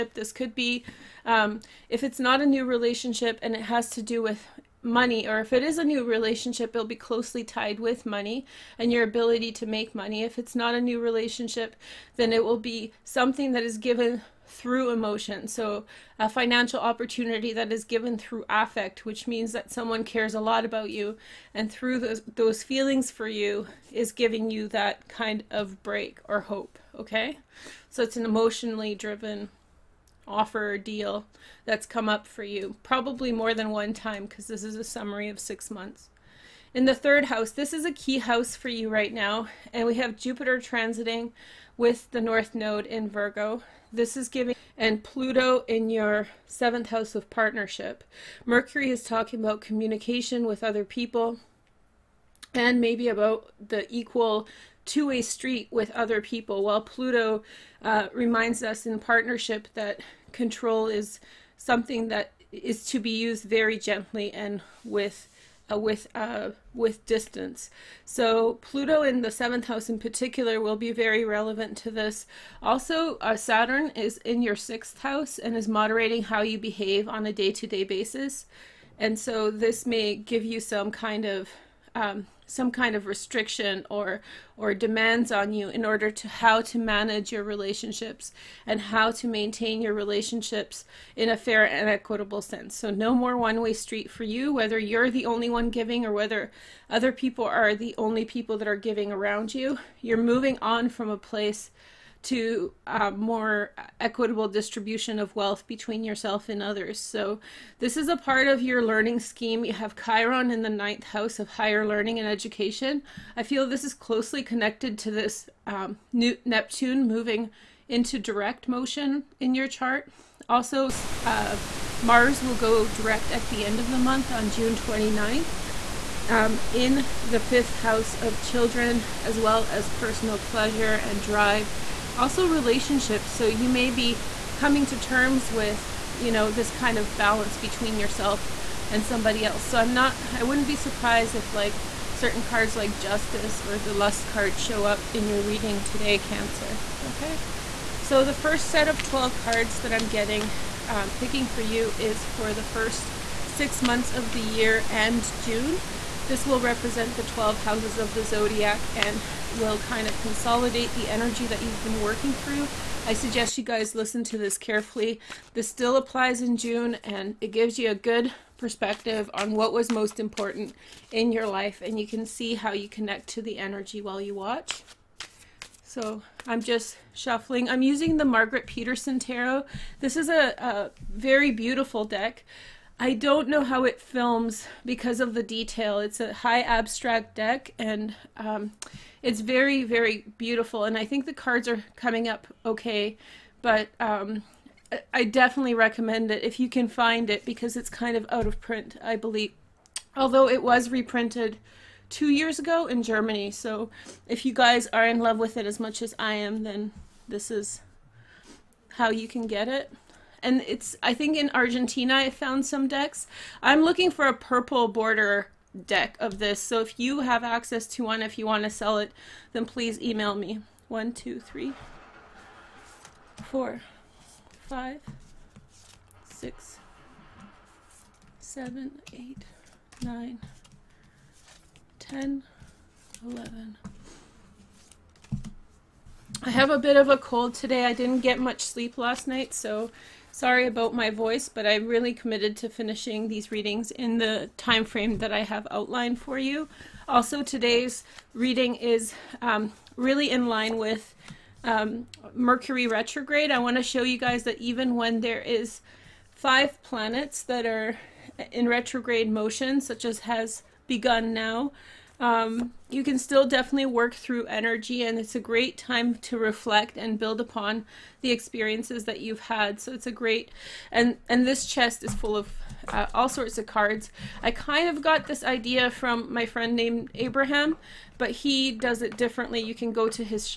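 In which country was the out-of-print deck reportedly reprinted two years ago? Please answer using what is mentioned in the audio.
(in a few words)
Germany.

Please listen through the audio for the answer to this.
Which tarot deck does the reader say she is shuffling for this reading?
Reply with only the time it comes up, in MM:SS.
02:58.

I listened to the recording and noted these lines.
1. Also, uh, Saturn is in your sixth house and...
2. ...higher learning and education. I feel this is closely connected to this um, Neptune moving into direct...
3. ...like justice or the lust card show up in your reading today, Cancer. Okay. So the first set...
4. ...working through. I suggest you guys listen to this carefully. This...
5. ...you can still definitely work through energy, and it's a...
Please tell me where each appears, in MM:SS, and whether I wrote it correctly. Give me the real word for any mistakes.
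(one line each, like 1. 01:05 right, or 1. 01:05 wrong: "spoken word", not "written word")
1. 01:12 right
2. 01:51 right
3. 02:22 right
4. 02:41 right
5. 04:22 right.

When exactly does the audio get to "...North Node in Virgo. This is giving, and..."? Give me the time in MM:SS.
00:42.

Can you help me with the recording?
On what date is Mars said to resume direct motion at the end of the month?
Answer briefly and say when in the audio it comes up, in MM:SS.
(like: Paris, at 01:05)
June 29, at 02:04.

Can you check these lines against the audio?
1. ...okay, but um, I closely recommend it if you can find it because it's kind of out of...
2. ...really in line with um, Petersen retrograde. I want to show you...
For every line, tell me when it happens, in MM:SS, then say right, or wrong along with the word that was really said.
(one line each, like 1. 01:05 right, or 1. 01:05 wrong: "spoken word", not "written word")
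1. 03:12 wrong: "definitely", not "closely"
2. 04:09 wrong: "Mercury", not "Petersen".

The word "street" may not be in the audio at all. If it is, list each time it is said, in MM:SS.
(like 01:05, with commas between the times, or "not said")
00:55, 01:33.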